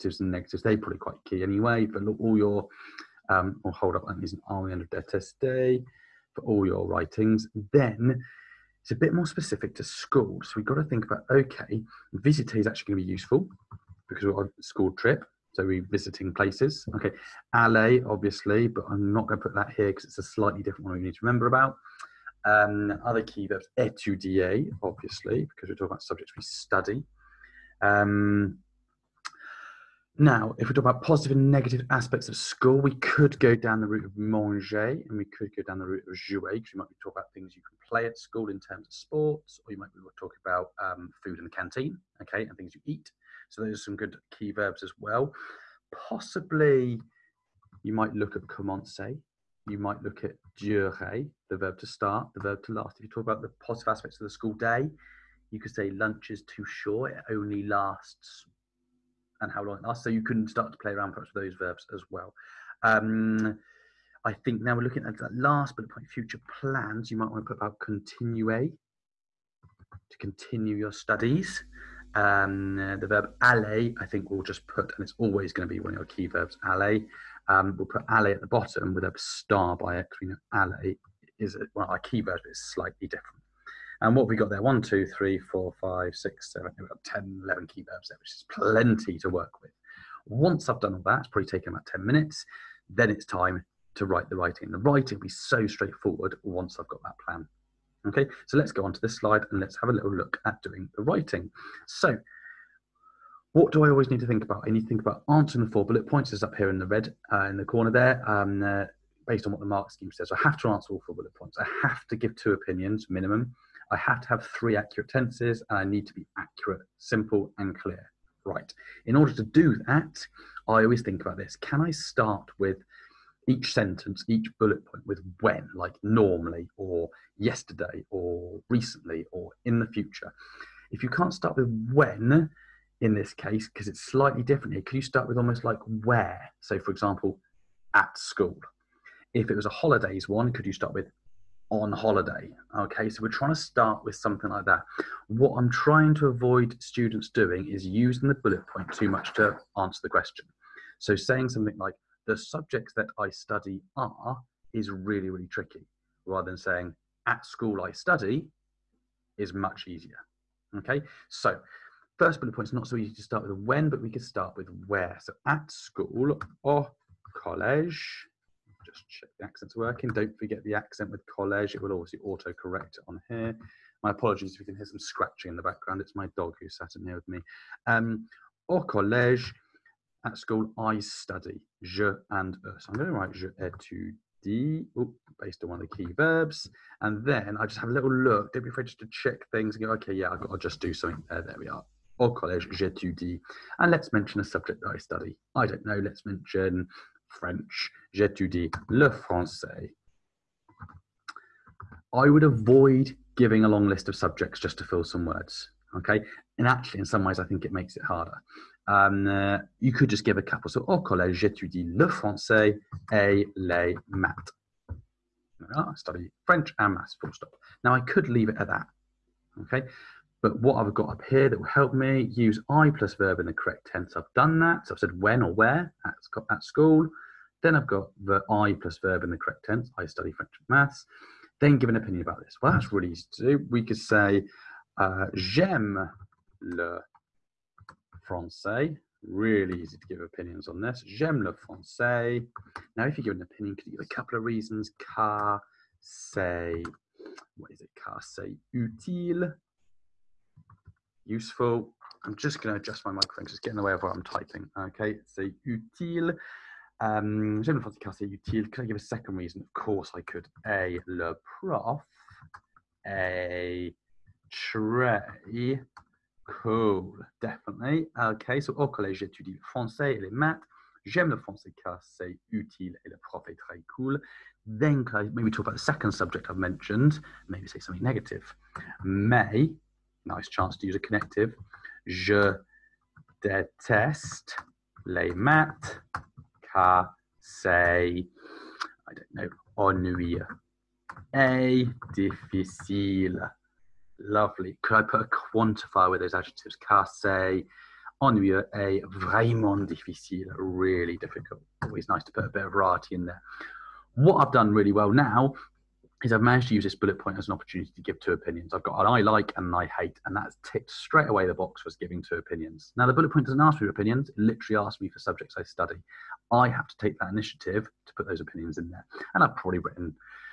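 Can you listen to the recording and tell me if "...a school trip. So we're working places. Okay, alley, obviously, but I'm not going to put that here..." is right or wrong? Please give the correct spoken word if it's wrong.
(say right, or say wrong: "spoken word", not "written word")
wrong: "visiting", not "working".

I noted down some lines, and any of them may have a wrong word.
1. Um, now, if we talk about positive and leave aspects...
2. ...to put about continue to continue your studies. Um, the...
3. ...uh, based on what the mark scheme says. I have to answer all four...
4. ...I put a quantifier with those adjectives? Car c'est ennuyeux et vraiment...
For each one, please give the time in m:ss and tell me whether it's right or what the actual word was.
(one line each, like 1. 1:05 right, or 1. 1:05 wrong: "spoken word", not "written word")
1. 0:27 wrong: "negative", not "leave"
2. 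1:07 right
3. 1:48 right
4. 4:54 right.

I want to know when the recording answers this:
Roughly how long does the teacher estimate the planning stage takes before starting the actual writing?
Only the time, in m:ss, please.
1:31.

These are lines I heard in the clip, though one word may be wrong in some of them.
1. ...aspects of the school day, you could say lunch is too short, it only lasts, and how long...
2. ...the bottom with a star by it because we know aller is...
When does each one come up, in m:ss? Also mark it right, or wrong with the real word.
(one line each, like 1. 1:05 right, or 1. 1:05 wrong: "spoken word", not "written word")
1. 0:53 right
2. 1:18 right.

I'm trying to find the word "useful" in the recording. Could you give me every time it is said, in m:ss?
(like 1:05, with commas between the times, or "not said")
0:13, 4:11.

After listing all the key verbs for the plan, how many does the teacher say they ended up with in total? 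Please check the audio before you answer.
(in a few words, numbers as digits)
11.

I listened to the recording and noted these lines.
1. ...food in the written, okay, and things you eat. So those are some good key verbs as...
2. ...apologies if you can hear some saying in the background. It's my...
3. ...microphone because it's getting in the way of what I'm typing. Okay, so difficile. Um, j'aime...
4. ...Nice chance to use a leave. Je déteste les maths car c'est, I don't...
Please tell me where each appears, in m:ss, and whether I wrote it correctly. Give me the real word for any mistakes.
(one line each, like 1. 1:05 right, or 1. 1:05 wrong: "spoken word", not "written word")
1. 0:41 wrong: "canteen", not "written"
2. 2:54 wrong: "scratching", not "saying"
3. 4:13 wrong: "utile", not "difficile"
4. 4:40 wrong: "connective", not "leave".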